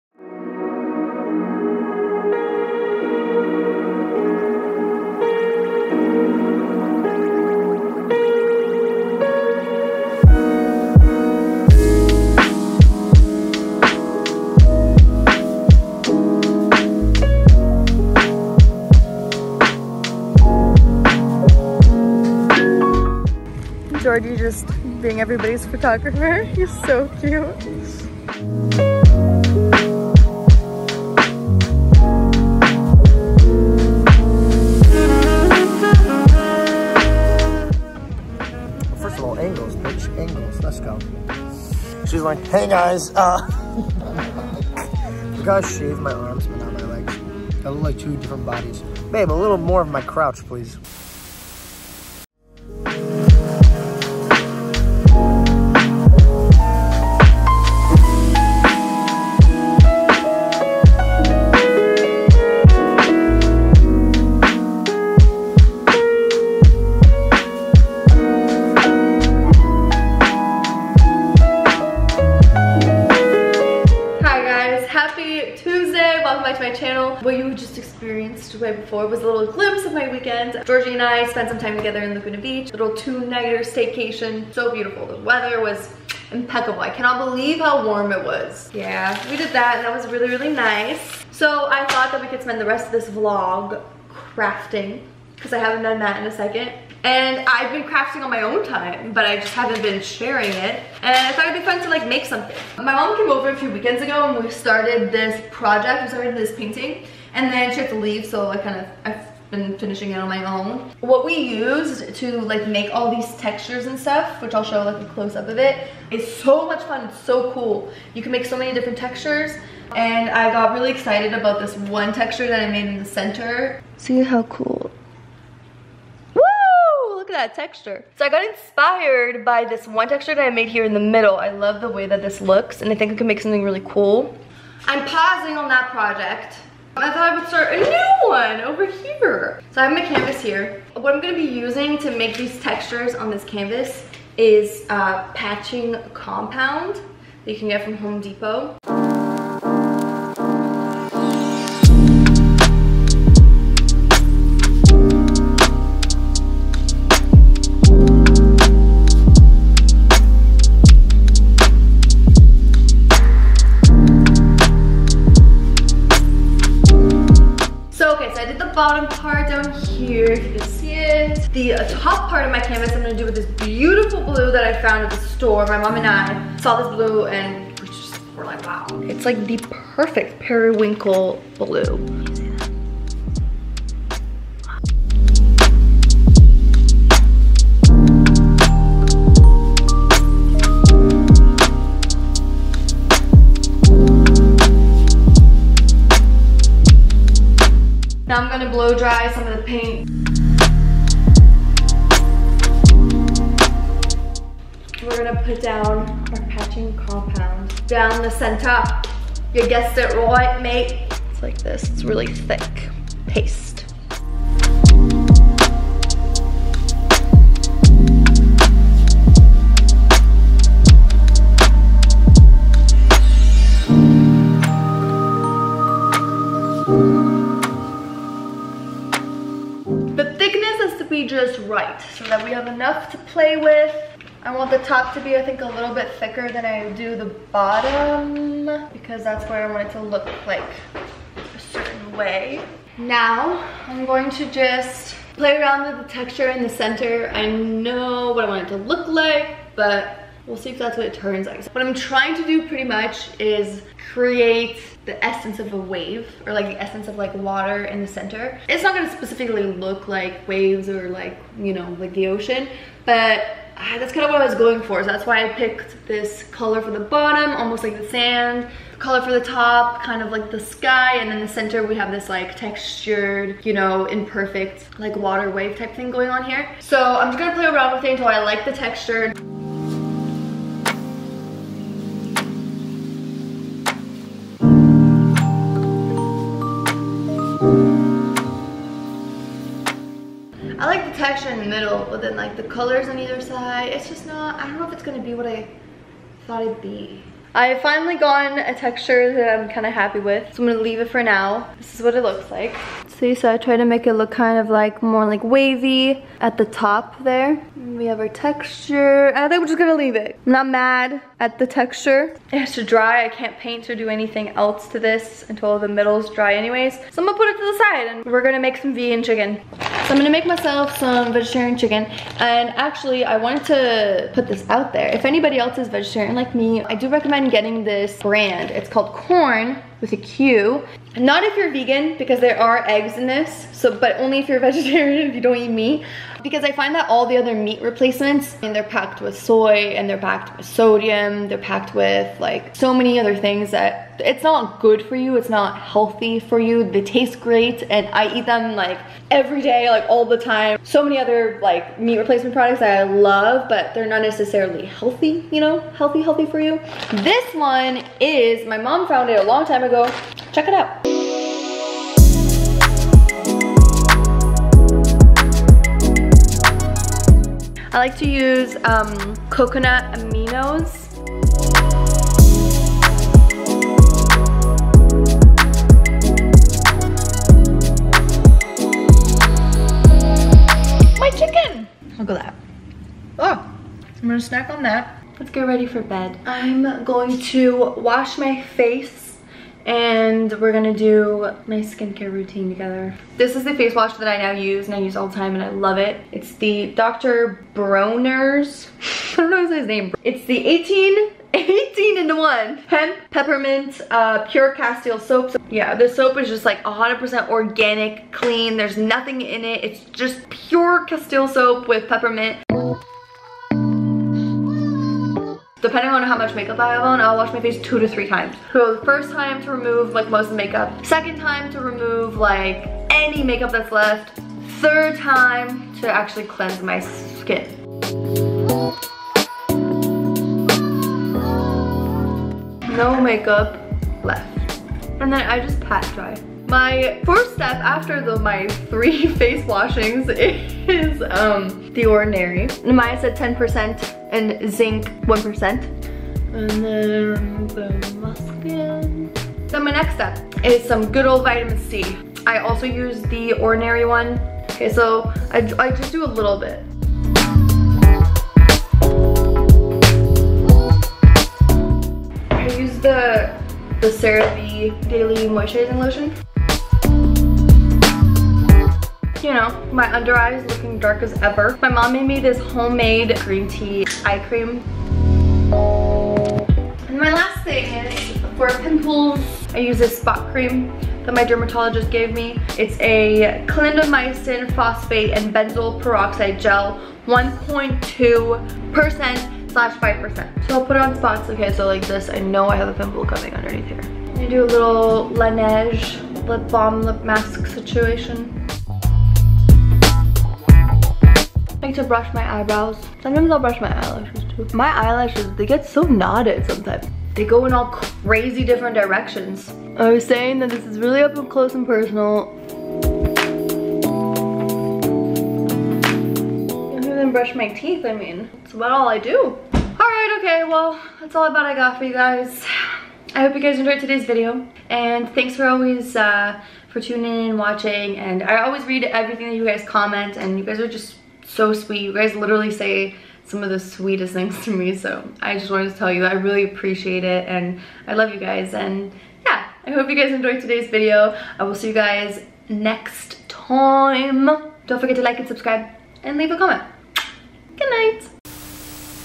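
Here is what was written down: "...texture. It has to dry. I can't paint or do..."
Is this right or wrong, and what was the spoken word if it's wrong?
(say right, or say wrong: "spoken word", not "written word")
right.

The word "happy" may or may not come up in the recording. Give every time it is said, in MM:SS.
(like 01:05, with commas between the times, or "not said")
04:59.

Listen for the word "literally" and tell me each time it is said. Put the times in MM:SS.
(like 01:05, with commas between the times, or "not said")
08:52.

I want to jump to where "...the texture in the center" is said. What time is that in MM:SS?
04:06.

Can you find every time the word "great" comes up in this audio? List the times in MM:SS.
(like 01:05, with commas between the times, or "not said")
05:47.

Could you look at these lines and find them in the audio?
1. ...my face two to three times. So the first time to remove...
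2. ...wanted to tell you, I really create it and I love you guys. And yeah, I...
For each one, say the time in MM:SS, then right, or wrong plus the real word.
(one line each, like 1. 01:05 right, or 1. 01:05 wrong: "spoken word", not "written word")
1. 06:57 right
2. 08:55 wrong: "appreciate", not "create".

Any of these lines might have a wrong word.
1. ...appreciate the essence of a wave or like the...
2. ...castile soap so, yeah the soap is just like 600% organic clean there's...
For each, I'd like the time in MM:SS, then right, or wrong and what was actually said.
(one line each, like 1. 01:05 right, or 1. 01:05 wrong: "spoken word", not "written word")
1. 04:14 wrong: "create", not "appreciate"
2. 06:44 wrong: "100", not "600".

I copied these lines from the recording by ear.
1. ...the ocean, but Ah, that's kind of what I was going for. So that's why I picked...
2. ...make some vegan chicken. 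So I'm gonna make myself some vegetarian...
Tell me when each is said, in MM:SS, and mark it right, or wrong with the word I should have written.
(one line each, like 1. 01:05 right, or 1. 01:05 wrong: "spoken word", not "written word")
1. 04:22 right
2. 05:18 right.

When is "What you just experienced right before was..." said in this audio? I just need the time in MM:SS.
01:17.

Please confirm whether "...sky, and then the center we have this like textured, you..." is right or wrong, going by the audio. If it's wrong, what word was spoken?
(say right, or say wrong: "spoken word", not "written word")
right.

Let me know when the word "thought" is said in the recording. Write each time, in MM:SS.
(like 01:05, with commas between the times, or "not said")
01:31, 01:41, 02:17, 04:56.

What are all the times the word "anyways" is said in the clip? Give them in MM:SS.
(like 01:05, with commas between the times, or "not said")
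05:16.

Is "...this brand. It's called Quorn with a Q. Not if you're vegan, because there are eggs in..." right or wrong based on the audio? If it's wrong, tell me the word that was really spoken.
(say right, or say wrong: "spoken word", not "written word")
right.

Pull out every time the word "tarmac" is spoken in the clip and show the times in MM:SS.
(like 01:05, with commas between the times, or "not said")
not said.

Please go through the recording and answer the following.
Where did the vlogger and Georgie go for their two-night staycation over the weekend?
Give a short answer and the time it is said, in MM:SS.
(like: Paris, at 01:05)
Laguna Beach, at 01:22.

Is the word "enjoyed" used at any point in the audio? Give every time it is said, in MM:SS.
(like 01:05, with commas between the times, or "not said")
08:43, 09:00.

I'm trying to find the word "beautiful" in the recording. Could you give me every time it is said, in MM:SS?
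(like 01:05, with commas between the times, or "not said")
01:24, 02:53.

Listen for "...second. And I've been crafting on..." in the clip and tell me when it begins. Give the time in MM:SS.
01:36.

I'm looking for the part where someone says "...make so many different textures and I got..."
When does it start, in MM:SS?
01:58.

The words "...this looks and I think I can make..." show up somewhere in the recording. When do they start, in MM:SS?
02:12.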